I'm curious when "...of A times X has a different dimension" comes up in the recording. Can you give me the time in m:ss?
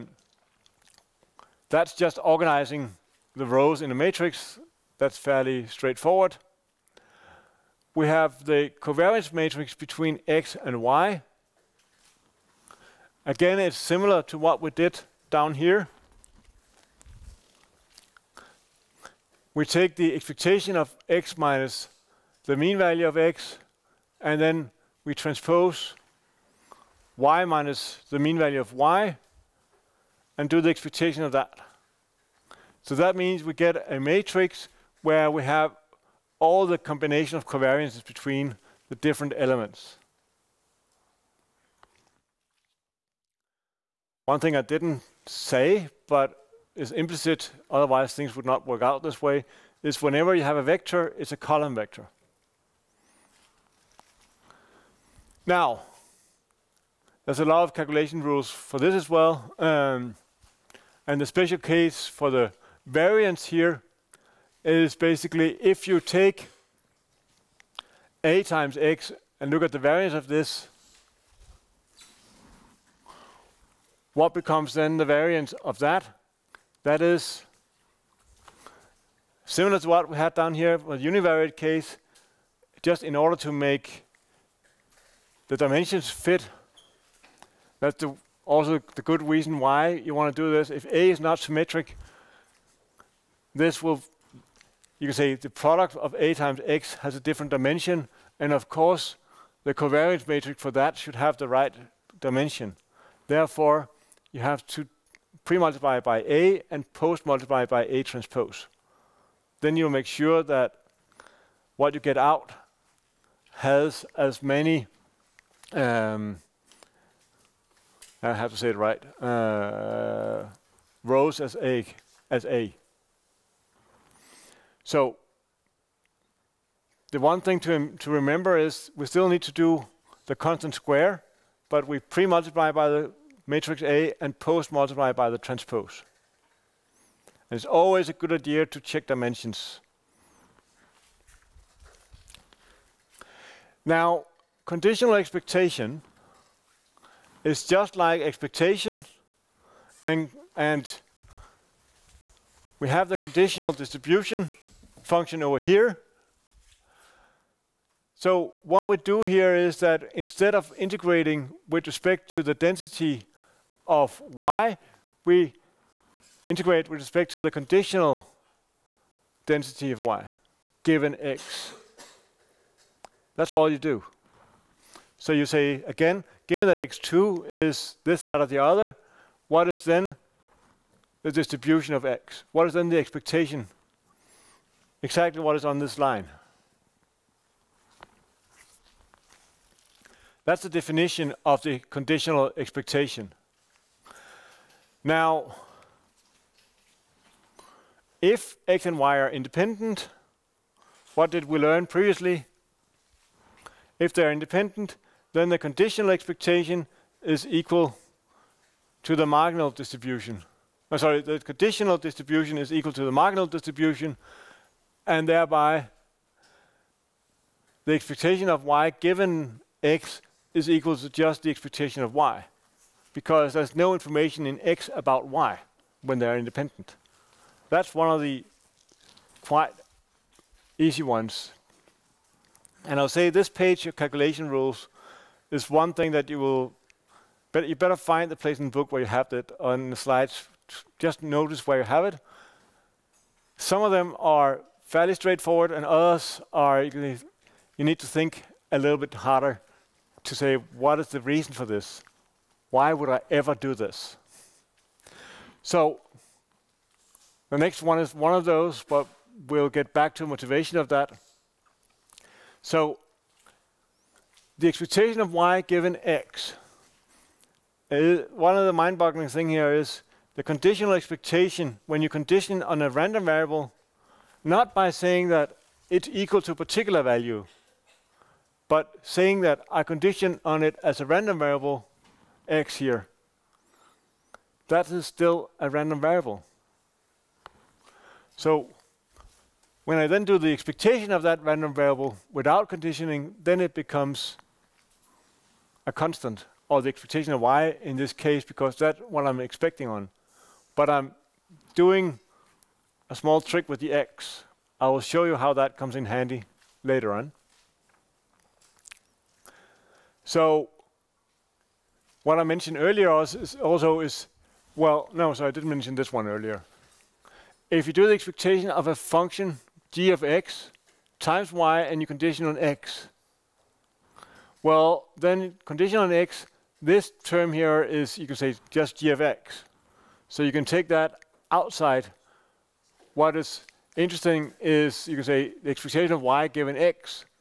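1:35.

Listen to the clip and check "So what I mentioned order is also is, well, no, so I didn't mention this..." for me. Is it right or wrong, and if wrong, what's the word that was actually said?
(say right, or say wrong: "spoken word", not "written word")
wrong: "earlier", not "order".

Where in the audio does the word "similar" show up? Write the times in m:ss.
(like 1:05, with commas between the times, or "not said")
0:13, 1:19.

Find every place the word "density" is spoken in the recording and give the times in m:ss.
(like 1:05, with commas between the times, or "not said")
2:42, 2:49.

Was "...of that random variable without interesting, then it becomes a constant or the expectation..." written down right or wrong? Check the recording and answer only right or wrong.
wrong.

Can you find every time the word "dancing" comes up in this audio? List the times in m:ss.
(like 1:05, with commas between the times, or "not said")
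not said.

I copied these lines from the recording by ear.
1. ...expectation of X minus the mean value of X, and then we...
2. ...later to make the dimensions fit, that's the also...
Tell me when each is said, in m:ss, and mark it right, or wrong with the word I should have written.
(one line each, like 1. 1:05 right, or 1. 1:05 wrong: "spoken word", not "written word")
1. 0:20 right
2. 1:23 wrong: "order", not "later".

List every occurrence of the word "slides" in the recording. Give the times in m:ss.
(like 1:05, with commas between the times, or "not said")
3:59.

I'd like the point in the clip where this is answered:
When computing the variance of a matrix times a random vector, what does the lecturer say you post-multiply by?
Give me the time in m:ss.
1:46.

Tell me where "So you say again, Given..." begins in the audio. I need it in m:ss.
2:55.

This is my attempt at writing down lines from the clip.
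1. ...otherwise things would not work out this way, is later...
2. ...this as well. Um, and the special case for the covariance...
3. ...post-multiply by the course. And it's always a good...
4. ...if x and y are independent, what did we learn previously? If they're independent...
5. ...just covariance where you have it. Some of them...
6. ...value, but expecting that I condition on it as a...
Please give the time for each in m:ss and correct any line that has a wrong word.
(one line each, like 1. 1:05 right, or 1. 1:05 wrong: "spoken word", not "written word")
1. 0:47 wrong: "whenever", not "later"
2. 0:58 wrong: "variance", not "covariance"
3. 2:14 wrong: "transpose", not "course"
4. 3:18 right
5. 4:00 wrong: "notice", not "covariance"
6. 4:37 wrong: "saying", not "expecting".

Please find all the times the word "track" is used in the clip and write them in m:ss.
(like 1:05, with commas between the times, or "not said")
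not said.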